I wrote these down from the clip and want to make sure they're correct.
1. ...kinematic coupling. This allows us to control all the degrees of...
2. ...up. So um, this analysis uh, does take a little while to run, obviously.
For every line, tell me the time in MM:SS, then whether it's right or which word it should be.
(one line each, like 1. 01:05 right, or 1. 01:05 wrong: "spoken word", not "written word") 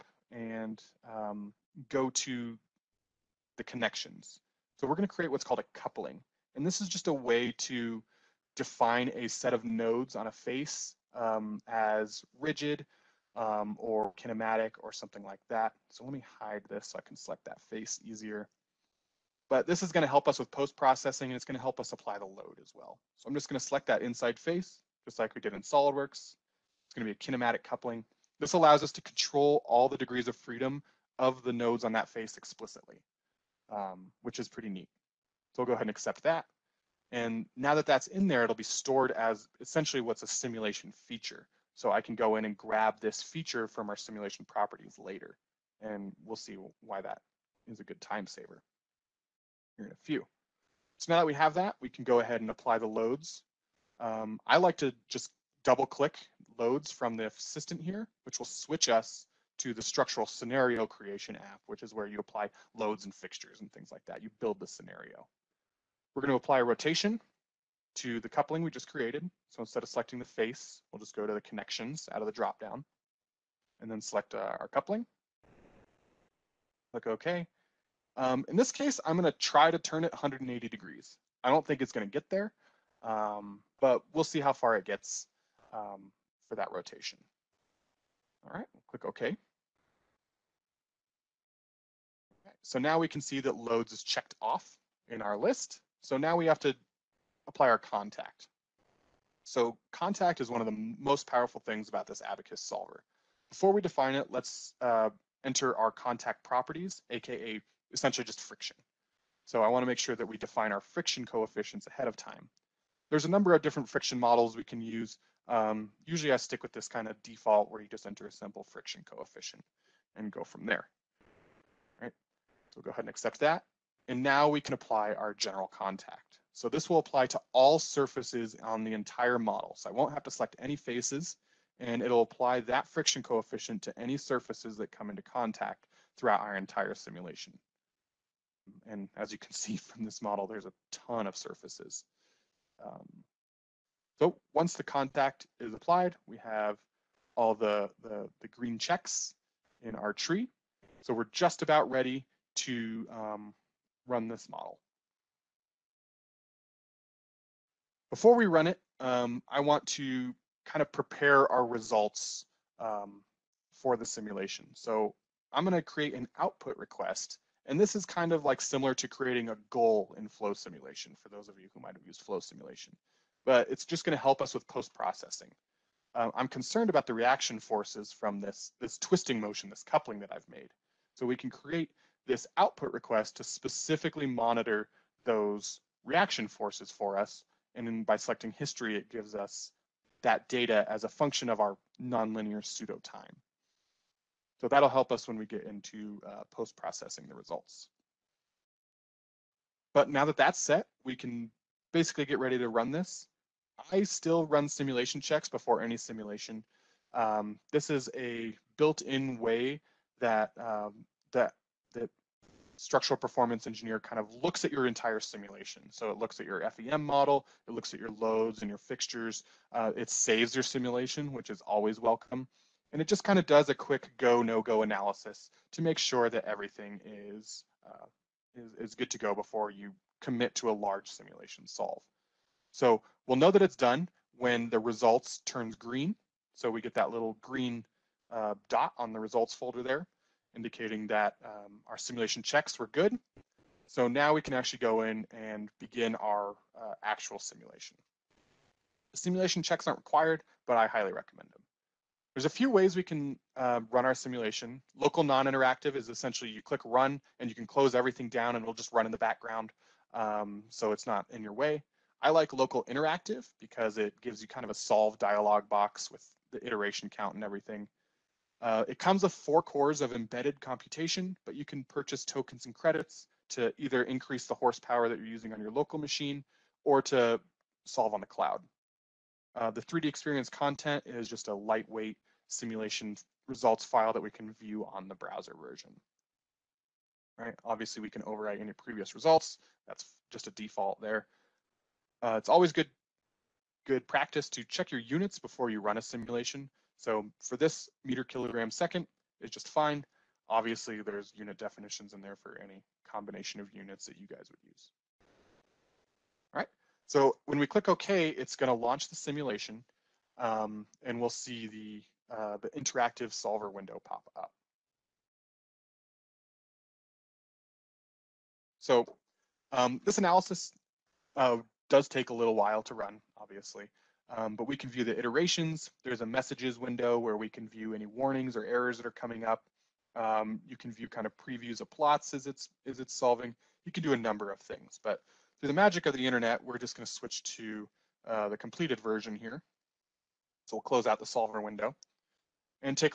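1. 00:27 right
2. 05:14 right.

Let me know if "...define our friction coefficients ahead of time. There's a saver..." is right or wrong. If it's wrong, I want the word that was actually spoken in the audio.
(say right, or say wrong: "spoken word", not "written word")
wrong: "number", not "saver".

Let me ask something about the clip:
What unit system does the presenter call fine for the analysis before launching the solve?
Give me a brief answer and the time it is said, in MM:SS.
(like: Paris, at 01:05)
Meter kilogram second, at 04:58.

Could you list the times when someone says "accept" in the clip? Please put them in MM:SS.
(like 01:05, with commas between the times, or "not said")
00:35, 02:03.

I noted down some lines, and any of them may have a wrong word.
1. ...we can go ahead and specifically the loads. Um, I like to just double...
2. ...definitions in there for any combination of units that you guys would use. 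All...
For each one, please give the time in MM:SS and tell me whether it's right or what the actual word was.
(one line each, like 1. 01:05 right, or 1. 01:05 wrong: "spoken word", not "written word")
1. 00:51 wrong: "apply", not "specifically"
2. 05:01 right.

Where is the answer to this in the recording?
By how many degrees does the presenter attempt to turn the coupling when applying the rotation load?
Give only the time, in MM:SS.
01:20.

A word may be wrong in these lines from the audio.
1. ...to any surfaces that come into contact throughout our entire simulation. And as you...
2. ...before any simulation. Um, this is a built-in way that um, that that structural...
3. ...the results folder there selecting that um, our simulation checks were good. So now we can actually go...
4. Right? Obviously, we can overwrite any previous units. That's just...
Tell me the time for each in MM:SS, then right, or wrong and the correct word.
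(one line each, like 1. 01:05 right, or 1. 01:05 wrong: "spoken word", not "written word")
1. 02:13 right
2. 03:25 right
3. 03:59 wrong: "indicating", not "selecting"
4. 04:47 wrong: "results", not "units".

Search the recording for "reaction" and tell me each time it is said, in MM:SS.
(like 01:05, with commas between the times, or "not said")
02:57, 03:06.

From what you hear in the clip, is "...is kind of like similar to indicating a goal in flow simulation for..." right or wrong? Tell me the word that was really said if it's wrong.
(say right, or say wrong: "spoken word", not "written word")
wrong: "creating", not "indicating".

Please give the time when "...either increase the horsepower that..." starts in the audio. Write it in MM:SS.
04:33.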